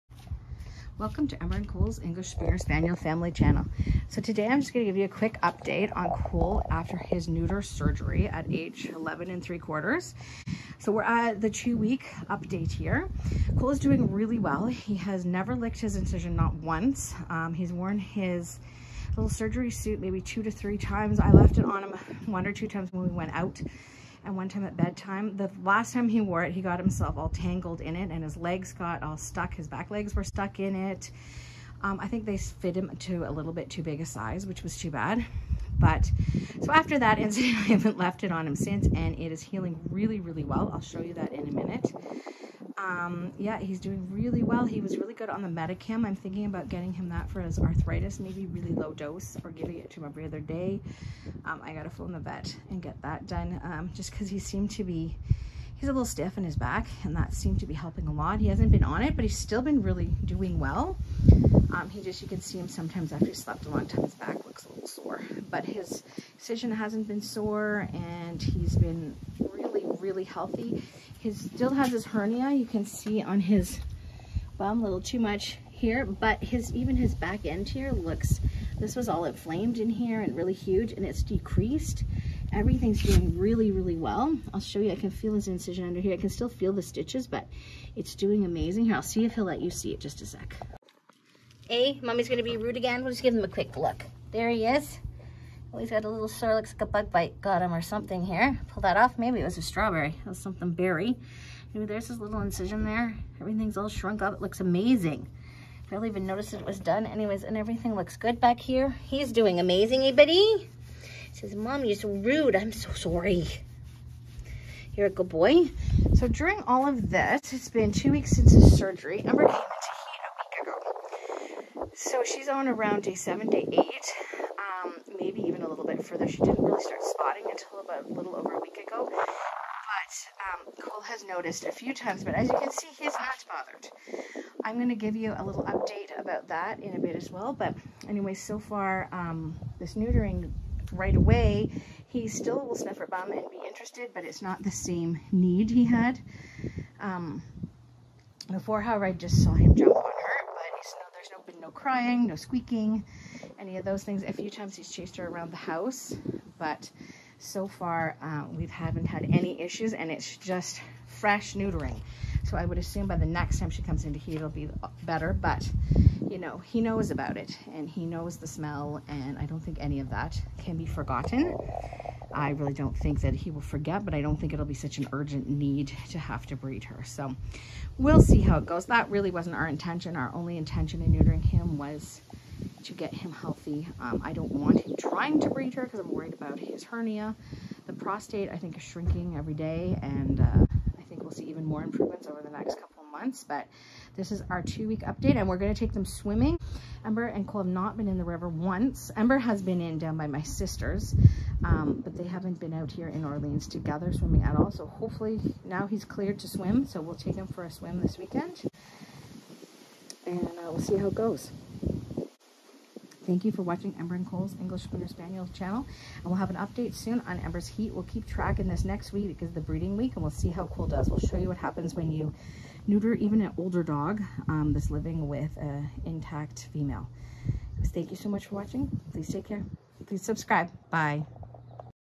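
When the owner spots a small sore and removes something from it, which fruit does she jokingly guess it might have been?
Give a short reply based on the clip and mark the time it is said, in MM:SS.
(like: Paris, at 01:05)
strawberry, at 01:39.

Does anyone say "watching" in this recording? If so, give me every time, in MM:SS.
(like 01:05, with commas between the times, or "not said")
03:33, 03:48.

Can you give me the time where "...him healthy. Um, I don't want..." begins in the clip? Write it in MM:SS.
03:03.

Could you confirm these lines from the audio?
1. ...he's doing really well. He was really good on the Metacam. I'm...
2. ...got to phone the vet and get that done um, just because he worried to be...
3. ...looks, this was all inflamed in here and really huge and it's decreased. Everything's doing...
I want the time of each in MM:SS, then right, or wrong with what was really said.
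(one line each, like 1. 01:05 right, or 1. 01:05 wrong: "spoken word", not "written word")
1. 00:43 right
2. 00:51 wrong: "seemed", not "worried"
3. 01:17 right.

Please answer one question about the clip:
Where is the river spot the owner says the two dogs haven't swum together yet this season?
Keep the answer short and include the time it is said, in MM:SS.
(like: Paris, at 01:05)
Orleans, at 03:23.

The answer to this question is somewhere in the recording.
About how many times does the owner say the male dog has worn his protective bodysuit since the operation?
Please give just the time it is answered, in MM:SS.
00:20.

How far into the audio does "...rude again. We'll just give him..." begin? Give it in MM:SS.
01:32.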